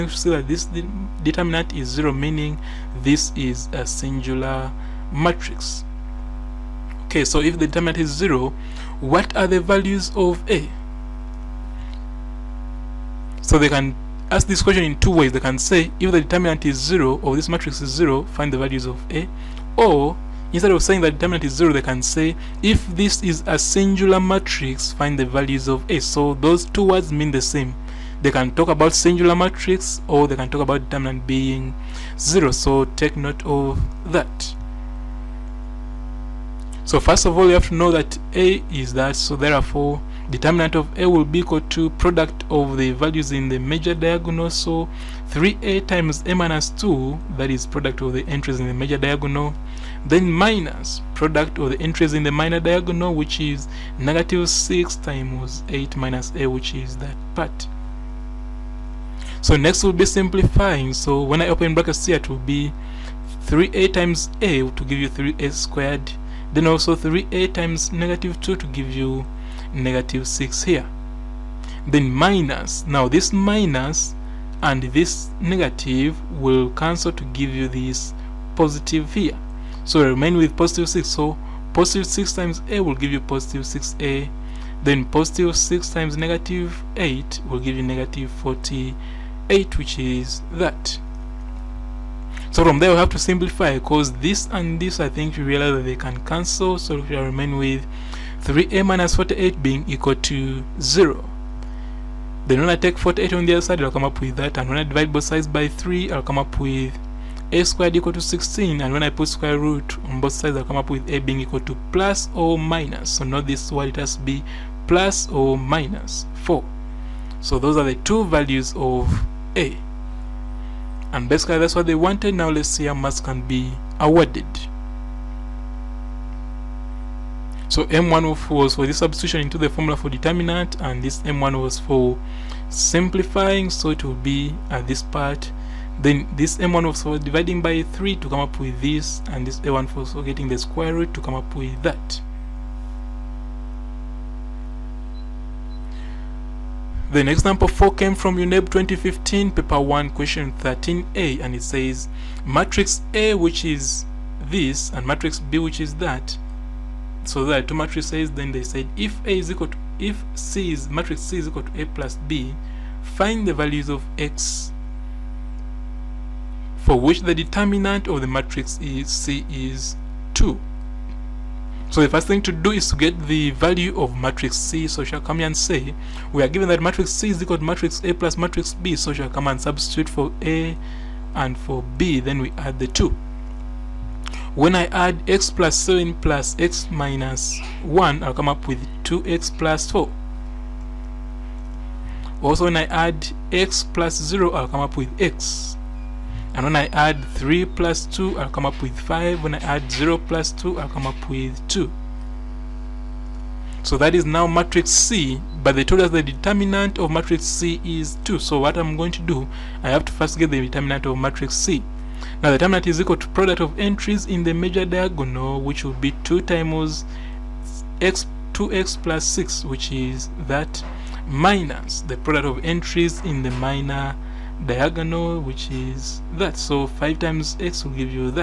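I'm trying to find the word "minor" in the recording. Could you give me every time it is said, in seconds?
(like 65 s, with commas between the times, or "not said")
52 s, 223 s.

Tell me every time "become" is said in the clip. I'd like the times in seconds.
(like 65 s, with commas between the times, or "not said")
not said.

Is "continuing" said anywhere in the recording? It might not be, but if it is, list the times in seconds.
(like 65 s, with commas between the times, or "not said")
not said.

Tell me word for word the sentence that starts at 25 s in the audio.
So those two words mean the same.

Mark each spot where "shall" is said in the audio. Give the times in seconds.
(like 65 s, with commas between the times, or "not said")
175 s, 179 s.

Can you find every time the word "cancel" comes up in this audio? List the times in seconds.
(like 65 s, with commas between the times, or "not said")
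76 s, 96 s.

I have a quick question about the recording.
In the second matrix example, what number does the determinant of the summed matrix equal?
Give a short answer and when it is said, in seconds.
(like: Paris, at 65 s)
2, at 167 s.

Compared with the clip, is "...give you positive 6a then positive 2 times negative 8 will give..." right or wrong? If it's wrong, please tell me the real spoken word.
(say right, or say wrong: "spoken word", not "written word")
wrong: "6", not "2".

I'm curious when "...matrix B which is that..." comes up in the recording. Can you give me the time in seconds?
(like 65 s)
155 s.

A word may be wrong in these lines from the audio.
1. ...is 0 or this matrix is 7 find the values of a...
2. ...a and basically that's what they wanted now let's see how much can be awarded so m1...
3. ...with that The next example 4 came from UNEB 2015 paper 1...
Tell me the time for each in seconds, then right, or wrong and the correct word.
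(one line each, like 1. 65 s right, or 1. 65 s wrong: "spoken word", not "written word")
1. 16 s wrong: "0", not "7"
2. 119 s right
3. 141 s right.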